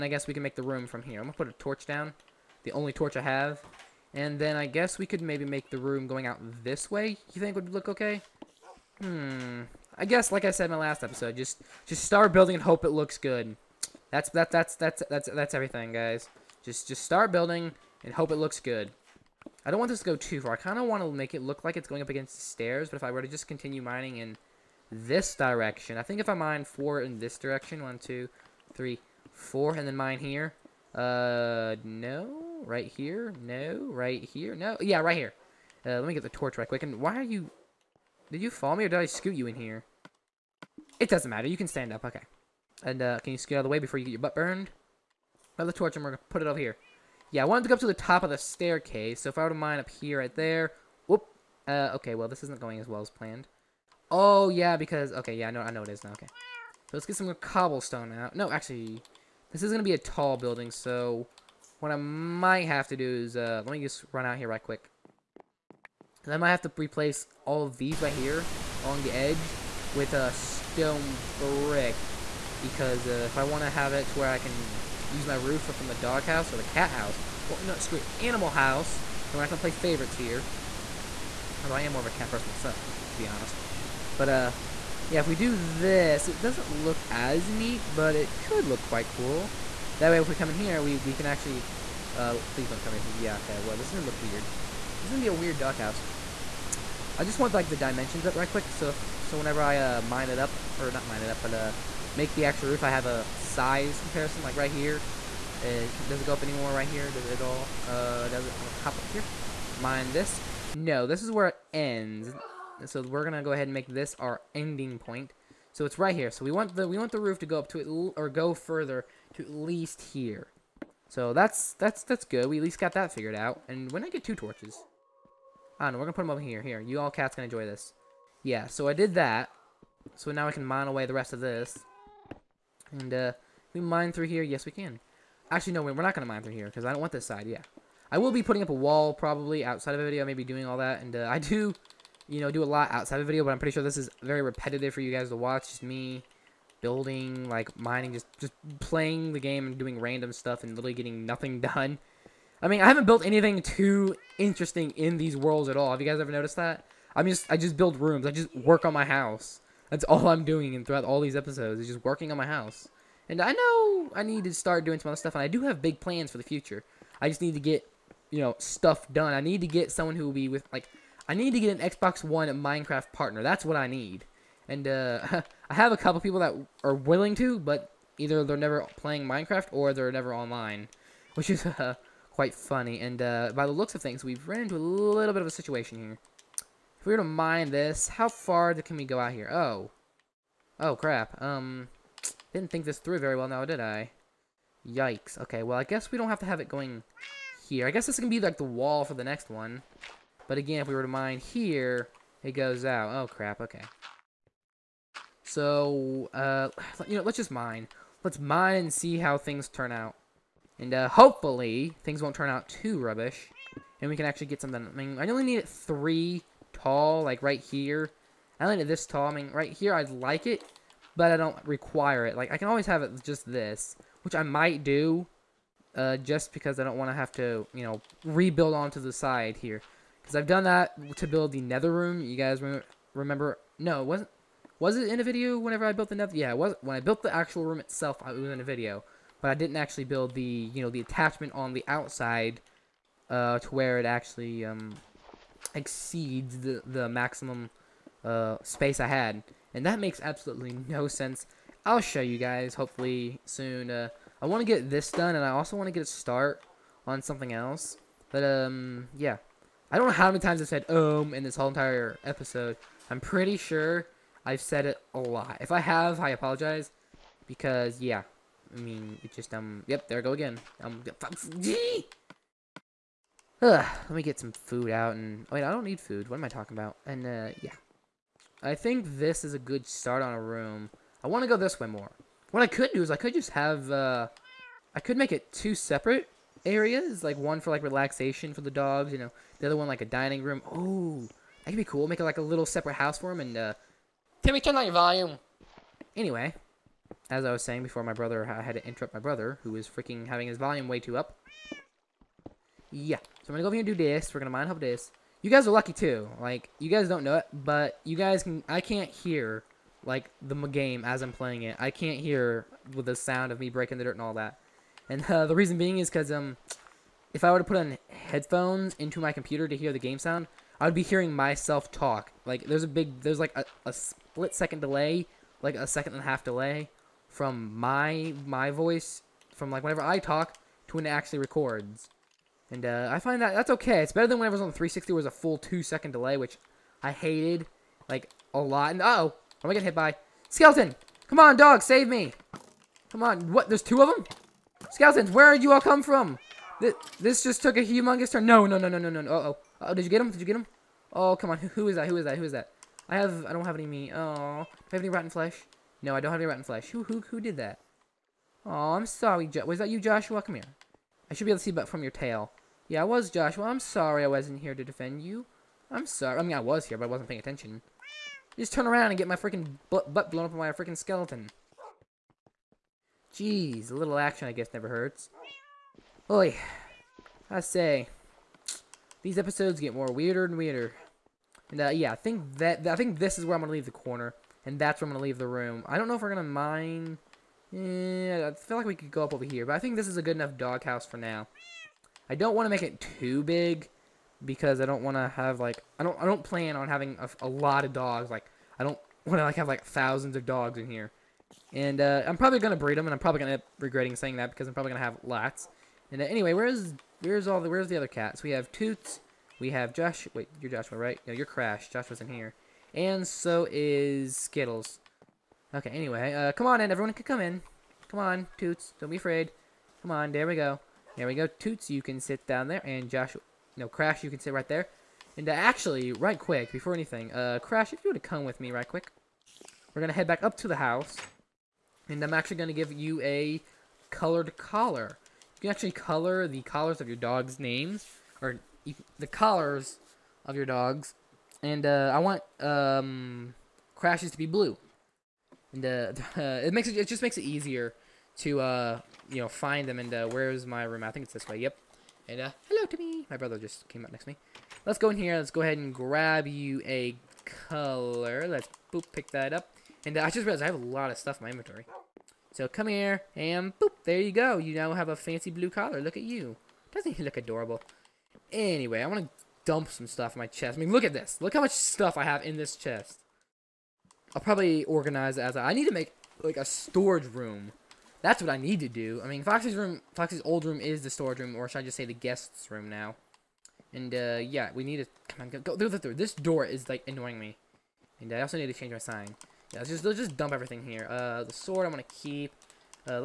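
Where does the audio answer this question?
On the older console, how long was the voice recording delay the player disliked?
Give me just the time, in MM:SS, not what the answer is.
05:35.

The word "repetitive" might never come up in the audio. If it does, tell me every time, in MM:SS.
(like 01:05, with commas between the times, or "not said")
02:24.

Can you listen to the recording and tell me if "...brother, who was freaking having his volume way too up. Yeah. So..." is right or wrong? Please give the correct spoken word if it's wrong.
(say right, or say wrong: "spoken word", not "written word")
right.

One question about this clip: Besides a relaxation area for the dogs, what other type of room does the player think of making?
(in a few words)
dining room.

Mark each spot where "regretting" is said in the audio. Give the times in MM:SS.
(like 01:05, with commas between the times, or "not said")
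06:43.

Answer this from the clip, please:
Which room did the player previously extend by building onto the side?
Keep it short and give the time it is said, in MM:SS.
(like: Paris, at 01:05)
the nether room, at 03:51.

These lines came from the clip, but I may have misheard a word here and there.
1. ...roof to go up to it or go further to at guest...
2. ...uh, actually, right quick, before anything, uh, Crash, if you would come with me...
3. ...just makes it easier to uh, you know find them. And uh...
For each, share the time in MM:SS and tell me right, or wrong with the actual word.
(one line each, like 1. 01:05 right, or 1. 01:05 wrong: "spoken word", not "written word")
1. 01:57 wrong: "least", not "guest"
2. 07:05 right
3. 07:27 right.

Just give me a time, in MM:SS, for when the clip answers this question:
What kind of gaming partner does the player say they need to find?
02:51.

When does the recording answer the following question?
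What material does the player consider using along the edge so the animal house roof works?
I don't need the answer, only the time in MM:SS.
01:10.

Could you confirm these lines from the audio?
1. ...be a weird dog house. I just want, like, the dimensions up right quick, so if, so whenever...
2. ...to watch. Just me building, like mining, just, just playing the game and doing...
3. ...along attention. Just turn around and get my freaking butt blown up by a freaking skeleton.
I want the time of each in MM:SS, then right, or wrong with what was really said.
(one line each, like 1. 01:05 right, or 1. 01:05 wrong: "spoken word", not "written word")
1. 01:35 right
2. 02:25 right
3. 06:07 wrong: "paying", not "along".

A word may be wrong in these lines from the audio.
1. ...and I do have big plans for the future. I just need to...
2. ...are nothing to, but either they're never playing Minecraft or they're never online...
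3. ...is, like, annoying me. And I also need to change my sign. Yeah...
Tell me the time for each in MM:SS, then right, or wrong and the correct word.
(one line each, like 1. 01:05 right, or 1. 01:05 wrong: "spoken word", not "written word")
1. 02:45 right
2. 02:56 wrong: "willing", not "nothing"
3. 08:06 right.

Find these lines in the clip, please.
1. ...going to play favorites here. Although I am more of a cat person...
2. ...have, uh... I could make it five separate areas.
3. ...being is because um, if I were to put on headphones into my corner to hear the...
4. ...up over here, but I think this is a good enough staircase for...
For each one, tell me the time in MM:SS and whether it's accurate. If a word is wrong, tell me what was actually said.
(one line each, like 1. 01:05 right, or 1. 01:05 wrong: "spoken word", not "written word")
1. 01:19 right
2. 04:43 wrong: "two", not "five"
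3. 05:15 wrong: "computer", not "corner"
4. 06:29 wrong: "doghouse", not "staircase".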